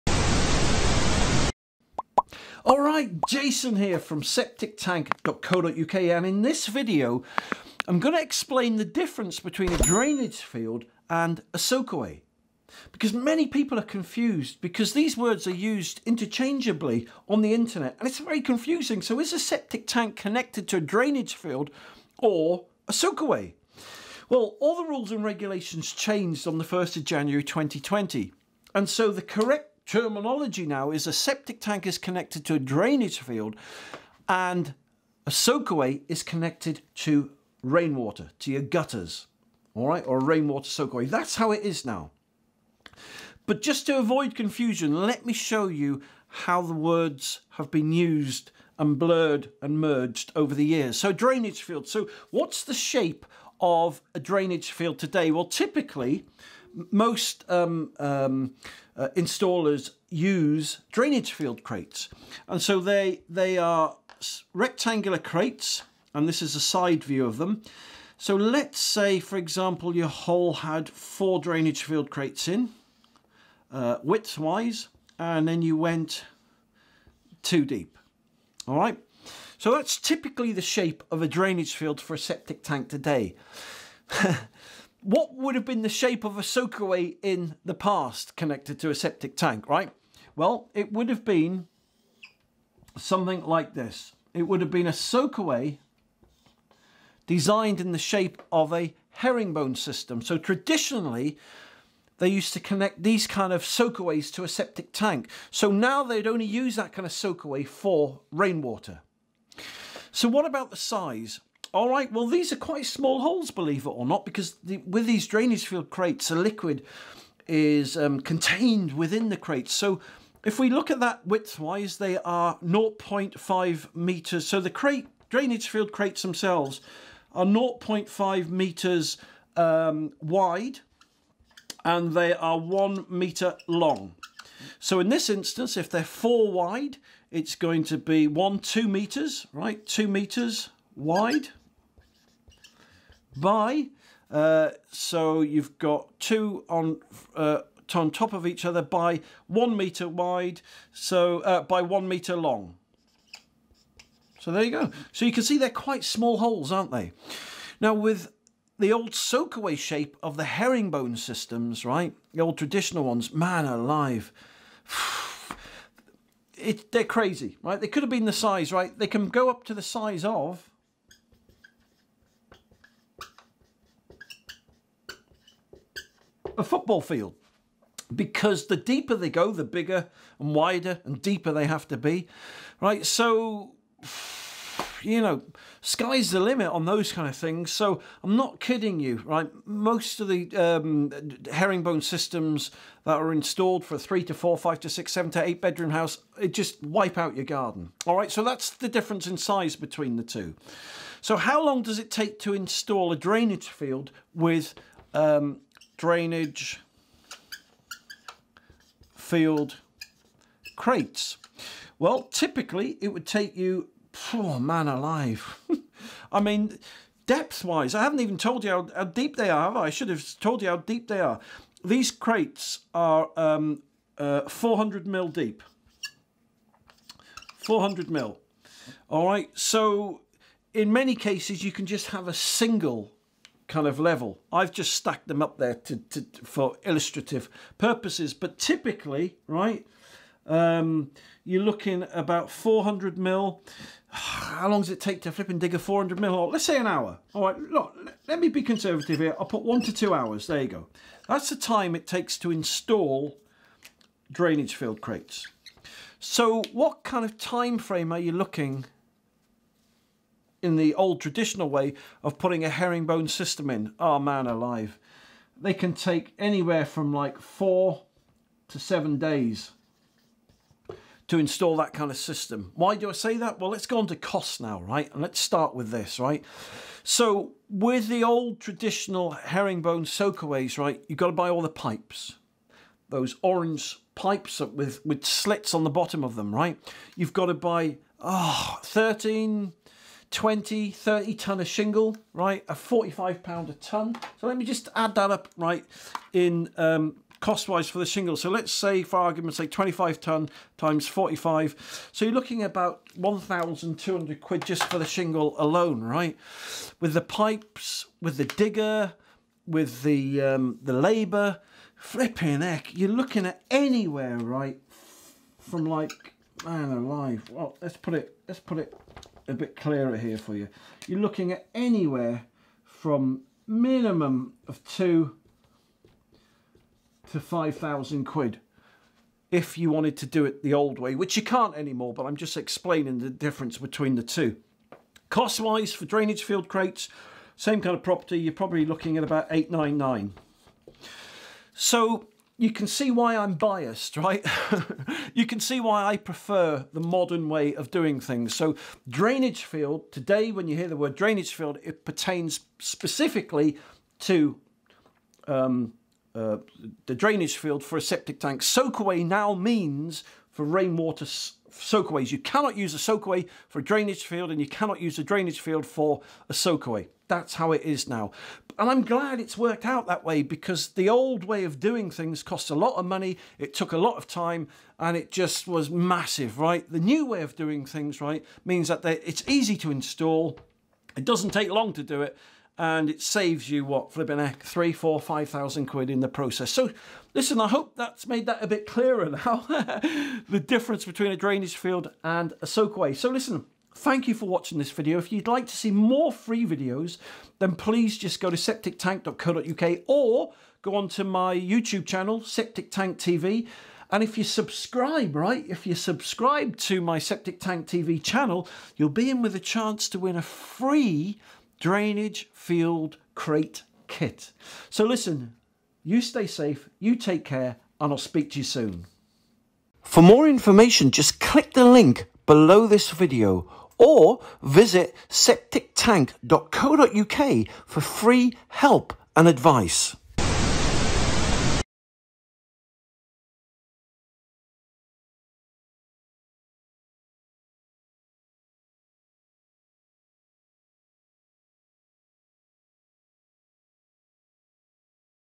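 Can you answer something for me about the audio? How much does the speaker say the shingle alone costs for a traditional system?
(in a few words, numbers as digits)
1,200 quid.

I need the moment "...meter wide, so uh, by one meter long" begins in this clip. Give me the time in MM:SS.
02:29.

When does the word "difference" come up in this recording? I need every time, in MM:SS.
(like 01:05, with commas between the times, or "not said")
00:08, 03:18, 05:33, 06:30.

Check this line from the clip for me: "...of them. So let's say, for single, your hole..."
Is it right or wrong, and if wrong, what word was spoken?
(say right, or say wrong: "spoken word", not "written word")
wrong: "example", not "single".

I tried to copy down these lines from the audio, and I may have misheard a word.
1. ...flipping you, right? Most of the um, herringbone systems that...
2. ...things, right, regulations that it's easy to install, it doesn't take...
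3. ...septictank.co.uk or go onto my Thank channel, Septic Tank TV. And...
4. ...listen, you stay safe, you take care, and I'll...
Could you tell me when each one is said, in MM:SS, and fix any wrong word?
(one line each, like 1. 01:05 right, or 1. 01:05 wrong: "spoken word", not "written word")
1. 03:08 wrong: "kidding", not "flipping"
2. 06:17 wrong: "means", not "regulations"
3. 06:38 wrong: "YouTube", not "Thank"
4. 06:55 right.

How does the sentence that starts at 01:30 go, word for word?
Well, it would have been something like this.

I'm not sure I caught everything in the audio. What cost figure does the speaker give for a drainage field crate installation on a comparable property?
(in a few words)
899.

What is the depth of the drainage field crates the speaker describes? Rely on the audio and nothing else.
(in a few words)
400 mil.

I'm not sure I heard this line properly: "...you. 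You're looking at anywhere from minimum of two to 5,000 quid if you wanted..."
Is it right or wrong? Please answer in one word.
right.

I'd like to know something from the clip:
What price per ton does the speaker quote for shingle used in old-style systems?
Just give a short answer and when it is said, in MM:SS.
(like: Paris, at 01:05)
45 pounds, at 04:52.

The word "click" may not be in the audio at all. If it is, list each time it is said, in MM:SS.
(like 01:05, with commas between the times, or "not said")
07:01.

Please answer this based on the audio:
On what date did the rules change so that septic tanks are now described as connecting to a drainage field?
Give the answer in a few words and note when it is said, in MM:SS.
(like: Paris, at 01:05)
1st of January 2020, at 00:26.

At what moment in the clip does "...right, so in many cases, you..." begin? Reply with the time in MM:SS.
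03:49.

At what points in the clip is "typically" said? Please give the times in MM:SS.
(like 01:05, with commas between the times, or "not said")
00:55, 01:19, 03:32, 03:58.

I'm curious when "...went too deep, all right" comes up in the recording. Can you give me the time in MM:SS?
01:15.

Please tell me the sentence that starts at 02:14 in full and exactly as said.
So in this instance, if they're four wide, it's going to be one, two meters, right?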